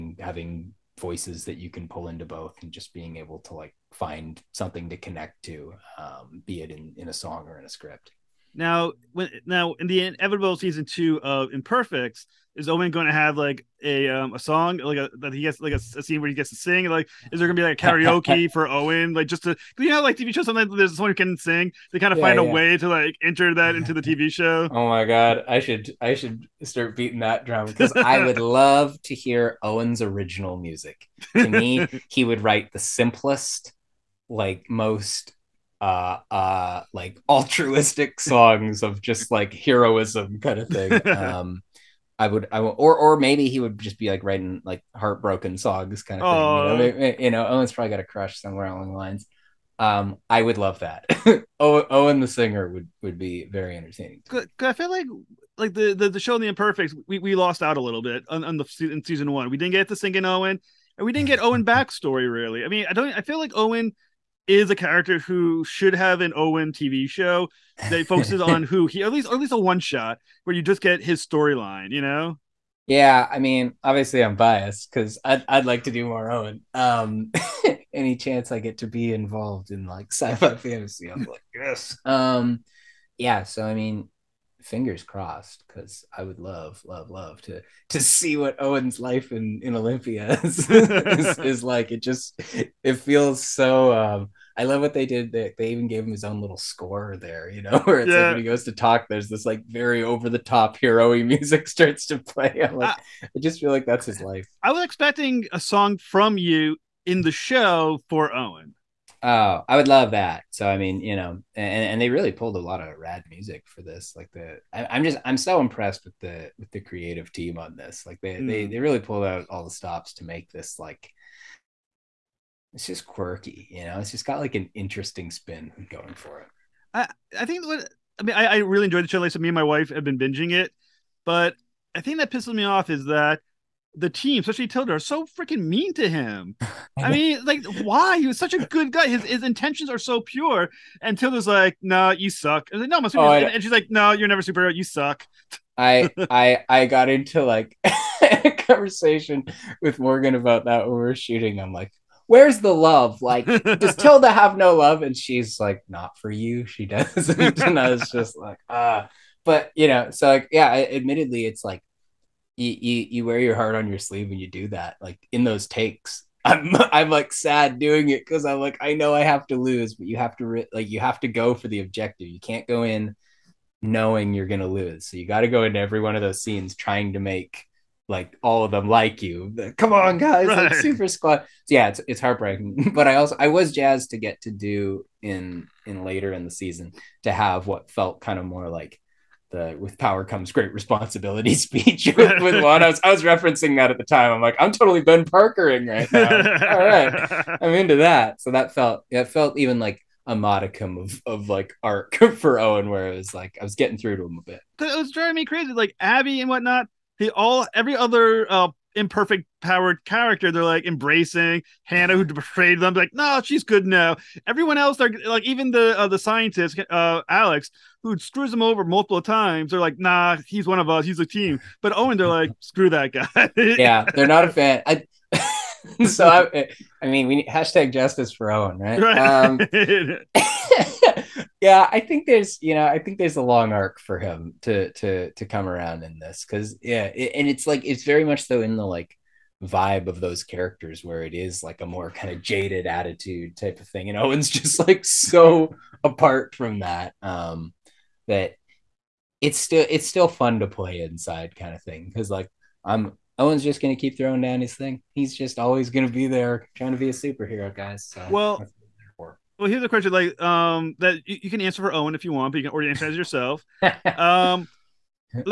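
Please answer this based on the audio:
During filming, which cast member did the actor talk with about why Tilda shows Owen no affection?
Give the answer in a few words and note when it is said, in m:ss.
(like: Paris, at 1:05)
Morgan, at 2:29.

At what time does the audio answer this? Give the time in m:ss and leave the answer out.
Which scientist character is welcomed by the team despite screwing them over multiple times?
3:37.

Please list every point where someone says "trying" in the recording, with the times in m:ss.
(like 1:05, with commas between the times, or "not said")
2:56, 4:16.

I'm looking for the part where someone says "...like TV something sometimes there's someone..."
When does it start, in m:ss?
0:20.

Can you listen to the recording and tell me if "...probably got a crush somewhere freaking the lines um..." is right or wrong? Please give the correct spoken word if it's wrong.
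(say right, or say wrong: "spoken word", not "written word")
wrong: "along", not "freaking".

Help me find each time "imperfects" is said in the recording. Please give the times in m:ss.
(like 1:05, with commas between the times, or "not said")
0:11, 0:56, 3:28.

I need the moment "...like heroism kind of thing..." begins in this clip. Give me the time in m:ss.
0:39.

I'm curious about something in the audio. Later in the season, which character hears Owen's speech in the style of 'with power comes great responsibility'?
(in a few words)
Juan.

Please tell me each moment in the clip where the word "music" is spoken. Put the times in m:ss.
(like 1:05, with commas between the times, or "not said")
0:30, 1:41, 1:53.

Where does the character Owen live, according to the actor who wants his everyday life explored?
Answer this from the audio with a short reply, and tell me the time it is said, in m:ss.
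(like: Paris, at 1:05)
Olympia, at 1:29.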